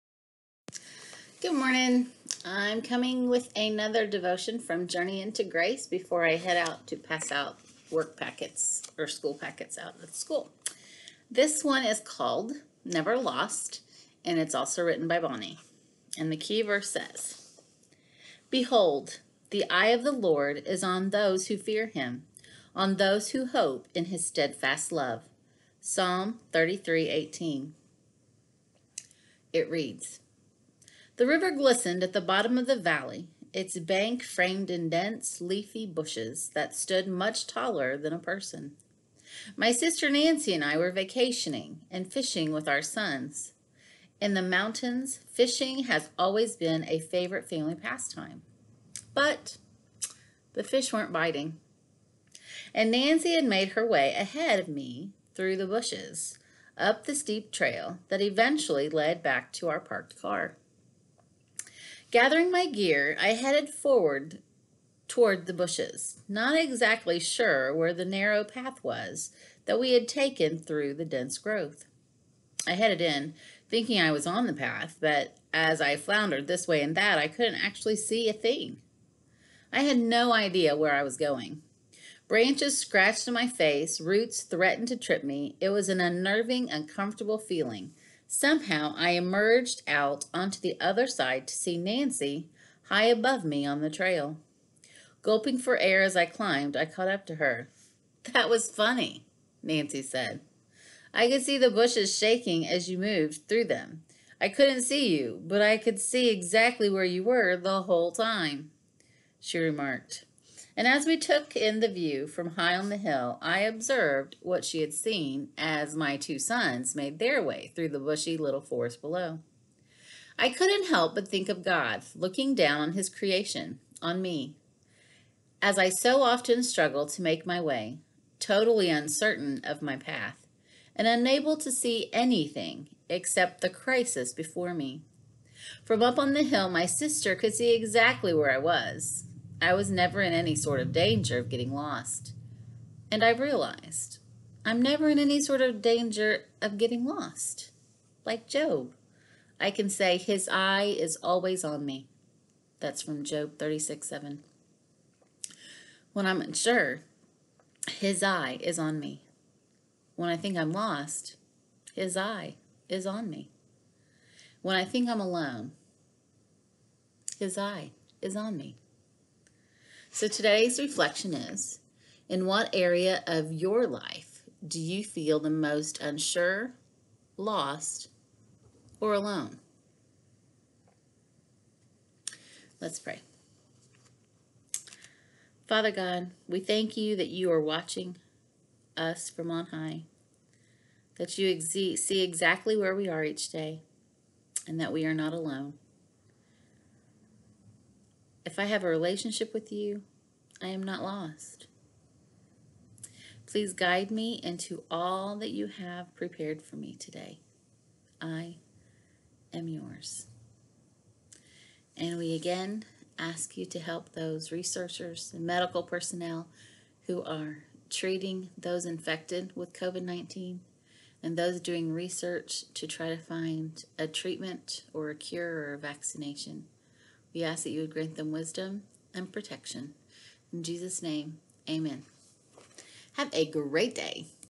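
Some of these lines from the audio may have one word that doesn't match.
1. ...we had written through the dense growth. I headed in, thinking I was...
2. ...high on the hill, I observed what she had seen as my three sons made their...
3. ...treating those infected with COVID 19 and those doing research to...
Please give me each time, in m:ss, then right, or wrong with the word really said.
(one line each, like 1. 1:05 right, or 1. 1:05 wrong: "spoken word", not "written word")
1. 1:09 wrong: "taken", not "written"
2. 1:52 wrong: "two", not "three"
3. 3:37 right.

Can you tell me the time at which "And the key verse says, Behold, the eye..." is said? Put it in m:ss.
0:16.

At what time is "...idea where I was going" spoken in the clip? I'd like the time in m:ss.
1:20.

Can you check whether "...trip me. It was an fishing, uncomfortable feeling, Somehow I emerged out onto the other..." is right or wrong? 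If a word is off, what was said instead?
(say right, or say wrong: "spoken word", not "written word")
wrong: "unnerving", not "fishing".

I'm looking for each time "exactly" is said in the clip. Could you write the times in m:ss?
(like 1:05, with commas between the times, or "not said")
1:06, 1:46, 2:17, 3:12.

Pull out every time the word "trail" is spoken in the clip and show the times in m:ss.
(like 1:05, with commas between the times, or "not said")
0:57, 1:33.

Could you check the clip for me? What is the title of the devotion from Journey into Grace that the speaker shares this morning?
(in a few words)
Never Lost.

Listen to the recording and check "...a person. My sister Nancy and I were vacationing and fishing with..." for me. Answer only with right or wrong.
right.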